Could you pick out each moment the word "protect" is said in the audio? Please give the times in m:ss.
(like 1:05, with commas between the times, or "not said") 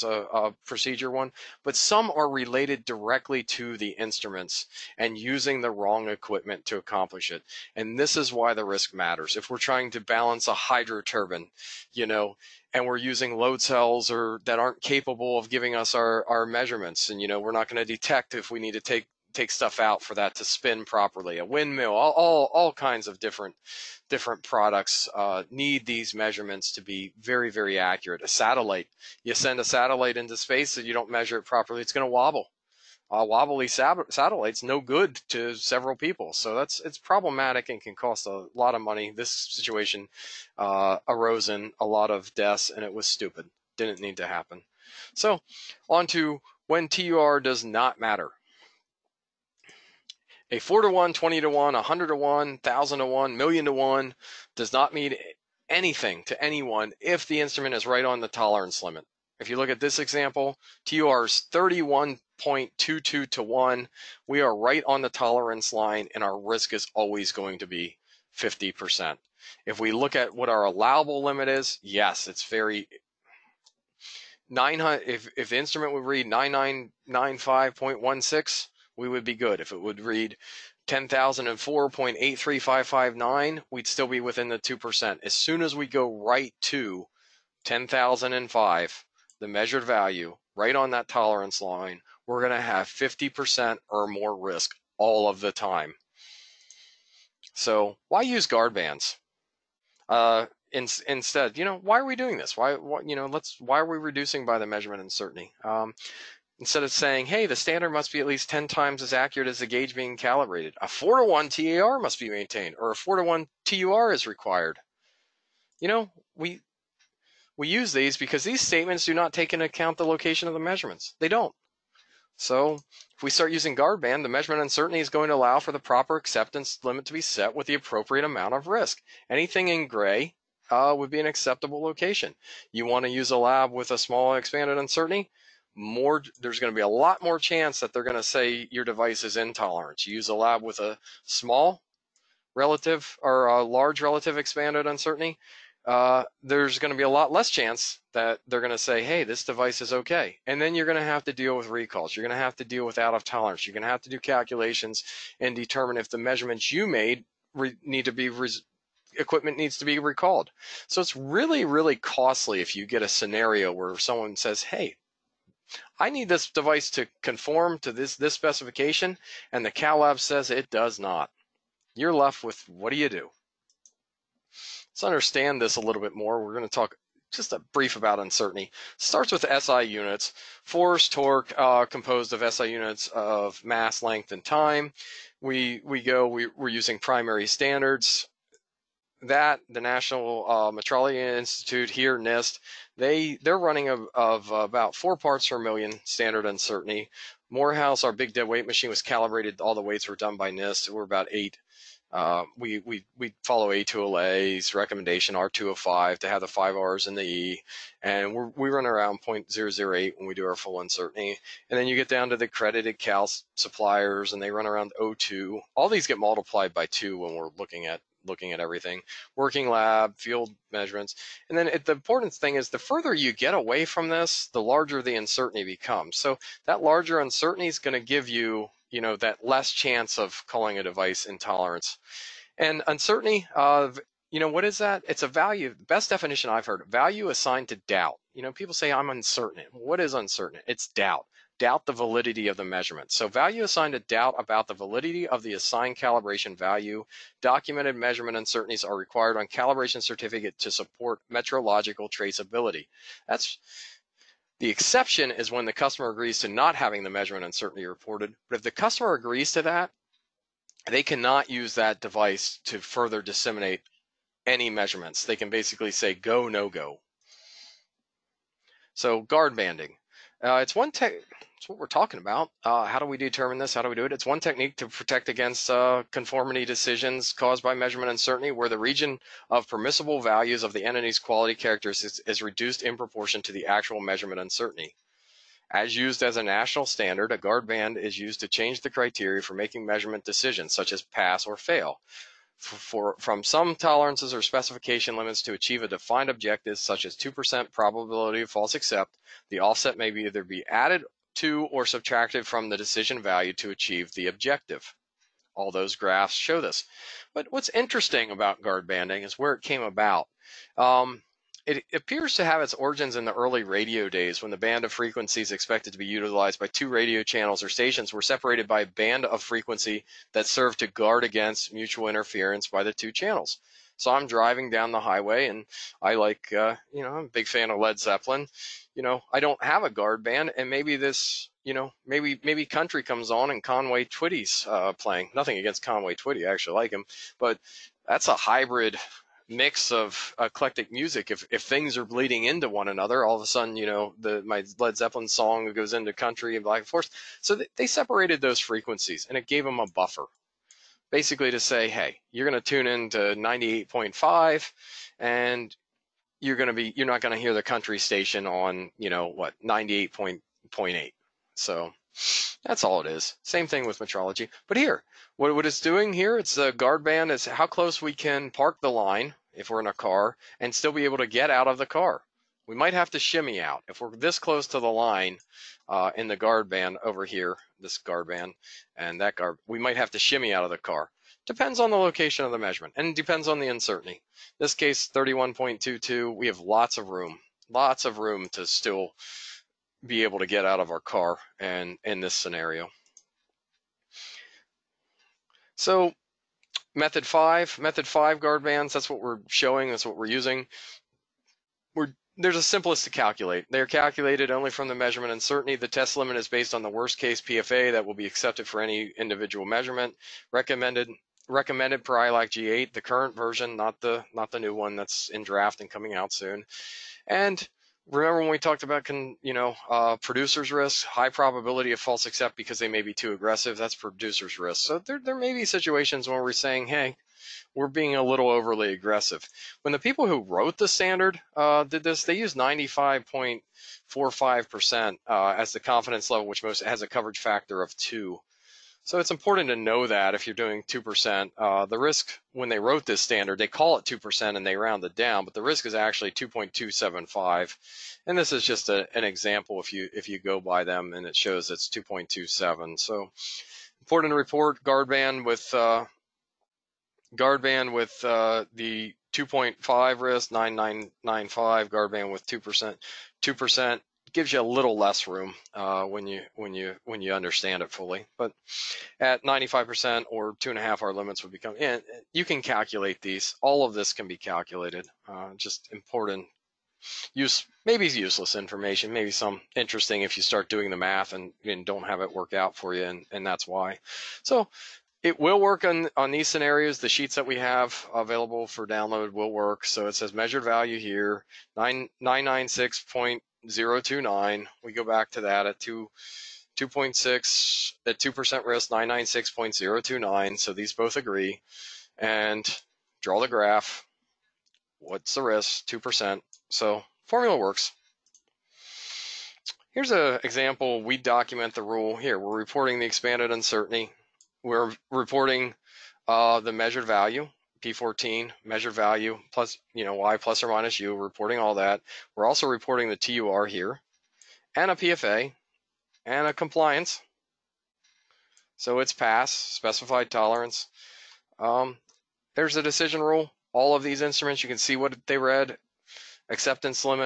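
4:34.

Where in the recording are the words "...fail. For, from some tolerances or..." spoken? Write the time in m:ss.
4:51.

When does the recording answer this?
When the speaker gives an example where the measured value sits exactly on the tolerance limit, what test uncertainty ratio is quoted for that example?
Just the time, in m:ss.
1:00.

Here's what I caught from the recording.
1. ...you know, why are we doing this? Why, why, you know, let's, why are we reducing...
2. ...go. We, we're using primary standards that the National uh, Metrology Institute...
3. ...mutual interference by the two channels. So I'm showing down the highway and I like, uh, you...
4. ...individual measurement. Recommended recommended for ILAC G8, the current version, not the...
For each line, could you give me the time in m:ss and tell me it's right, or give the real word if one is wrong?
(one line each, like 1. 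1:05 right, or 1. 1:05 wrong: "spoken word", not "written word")
1. 1:41 right
2. 3:06 right
3. 5:21 wrong: "driving", not "showing"
4. 6:49 right.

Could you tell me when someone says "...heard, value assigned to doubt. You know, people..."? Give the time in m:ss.
3:56.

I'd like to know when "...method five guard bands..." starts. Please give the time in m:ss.
6:37.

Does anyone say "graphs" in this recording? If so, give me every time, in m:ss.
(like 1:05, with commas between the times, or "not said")
5:05, 8:23.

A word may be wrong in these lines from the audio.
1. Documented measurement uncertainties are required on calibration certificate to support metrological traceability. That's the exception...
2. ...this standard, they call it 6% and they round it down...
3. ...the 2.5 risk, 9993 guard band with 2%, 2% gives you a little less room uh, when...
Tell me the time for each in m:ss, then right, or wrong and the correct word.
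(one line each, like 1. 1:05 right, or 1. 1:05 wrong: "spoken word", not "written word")
1. 4:07 right
2. 7:23 wrong: "2", not "6"
3. 7:38 wrong: "9995", not "9993".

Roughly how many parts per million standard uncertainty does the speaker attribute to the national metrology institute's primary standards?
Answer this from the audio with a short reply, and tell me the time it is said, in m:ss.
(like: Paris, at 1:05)
4, at 3:14.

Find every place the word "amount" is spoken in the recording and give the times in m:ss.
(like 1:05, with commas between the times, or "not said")
2:08.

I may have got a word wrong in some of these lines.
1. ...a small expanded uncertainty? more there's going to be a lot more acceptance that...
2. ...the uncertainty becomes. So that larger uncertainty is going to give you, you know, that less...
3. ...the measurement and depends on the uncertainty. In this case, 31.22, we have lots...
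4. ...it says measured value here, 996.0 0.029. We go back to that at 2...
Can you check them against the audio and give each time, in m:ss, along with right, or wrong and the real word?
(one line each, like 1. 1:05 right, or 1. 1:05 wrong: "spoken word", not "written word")
1. 2:13 wrong: "chance", not "acceptance"
2. 3:45 right
3. 6:22 right
4. 8:10 right.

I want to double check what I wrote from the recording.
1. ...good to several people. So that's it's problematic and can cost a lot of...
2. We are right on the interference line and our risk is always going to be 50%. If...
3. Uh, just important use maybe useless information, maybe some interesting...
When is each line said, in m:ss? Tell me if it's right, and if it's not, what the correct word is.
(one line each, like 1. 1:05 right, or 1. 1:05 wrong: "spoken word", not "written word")
1. 0:34 right
2. 1:04 wrong: "tolerance", not "interference"
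3. 7:55 right.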